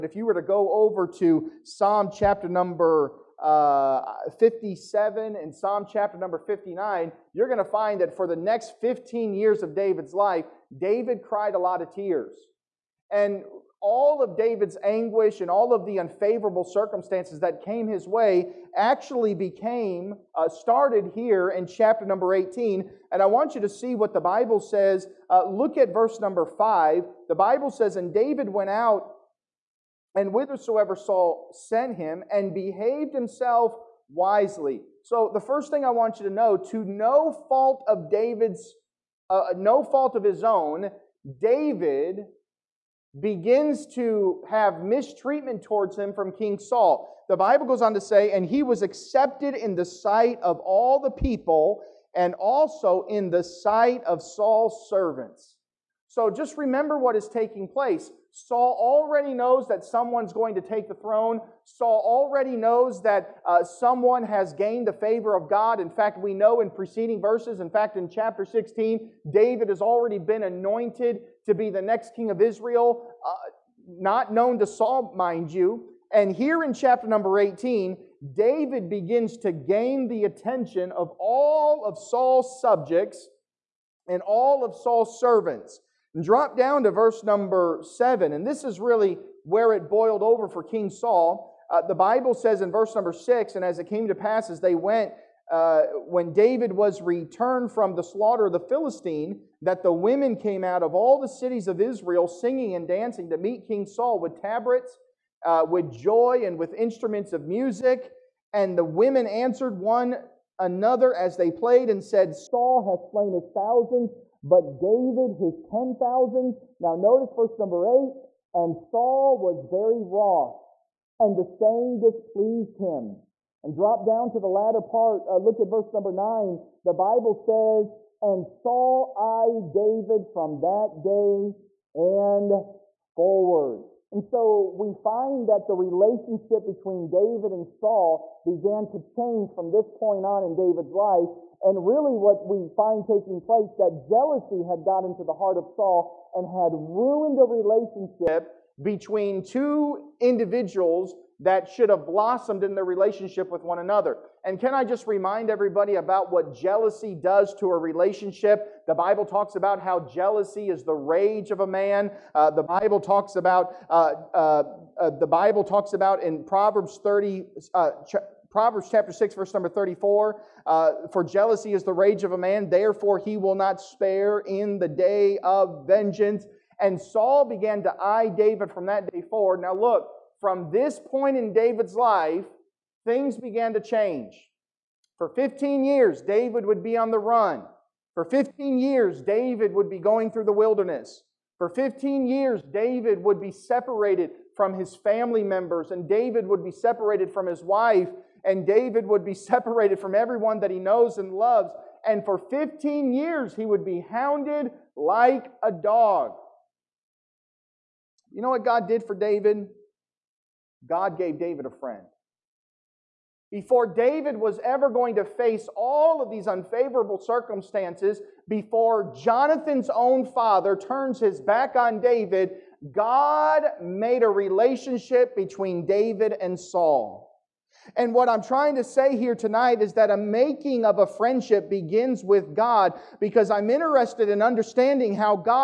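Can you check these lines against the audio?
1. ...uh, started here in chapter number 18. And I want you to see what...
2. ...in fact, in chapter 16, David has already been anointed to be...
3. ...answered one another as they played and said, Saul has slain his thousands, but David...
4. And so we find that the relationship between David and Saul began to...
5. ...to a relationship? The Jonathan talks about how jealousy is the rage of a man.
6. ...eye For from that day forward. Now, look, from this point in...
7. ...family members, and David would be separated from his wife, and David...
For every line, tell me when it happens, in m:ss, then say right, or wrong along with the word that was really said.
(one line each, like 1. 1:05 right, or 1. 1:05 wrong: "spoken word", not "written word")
1. 0:20 right
2. 1:07 right
3. 1:49 right
4. 2:14 right
5. 2:37 wrong: "Bible", not "Jonathan"
6. 2:58 wrong: "David", not "For"
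7. 3:14 right.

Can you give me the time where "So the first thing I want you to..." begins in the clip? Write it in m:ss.
0:35.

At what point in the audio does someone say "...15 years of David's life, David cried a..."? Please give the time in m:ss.
0:08.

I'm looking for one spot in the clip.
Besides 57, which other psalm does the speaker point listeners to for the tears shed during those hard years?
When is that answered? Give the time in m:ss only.
0:05.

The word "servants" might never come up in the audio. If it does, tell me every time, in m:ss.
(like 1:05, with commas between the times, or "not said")
0:54, 1:25.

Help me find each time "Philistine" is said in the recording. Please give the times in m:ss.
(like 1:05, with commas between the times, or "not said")
1:38.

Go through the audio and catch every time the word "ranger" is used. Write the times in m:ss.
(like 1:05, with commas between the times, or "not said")
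not said.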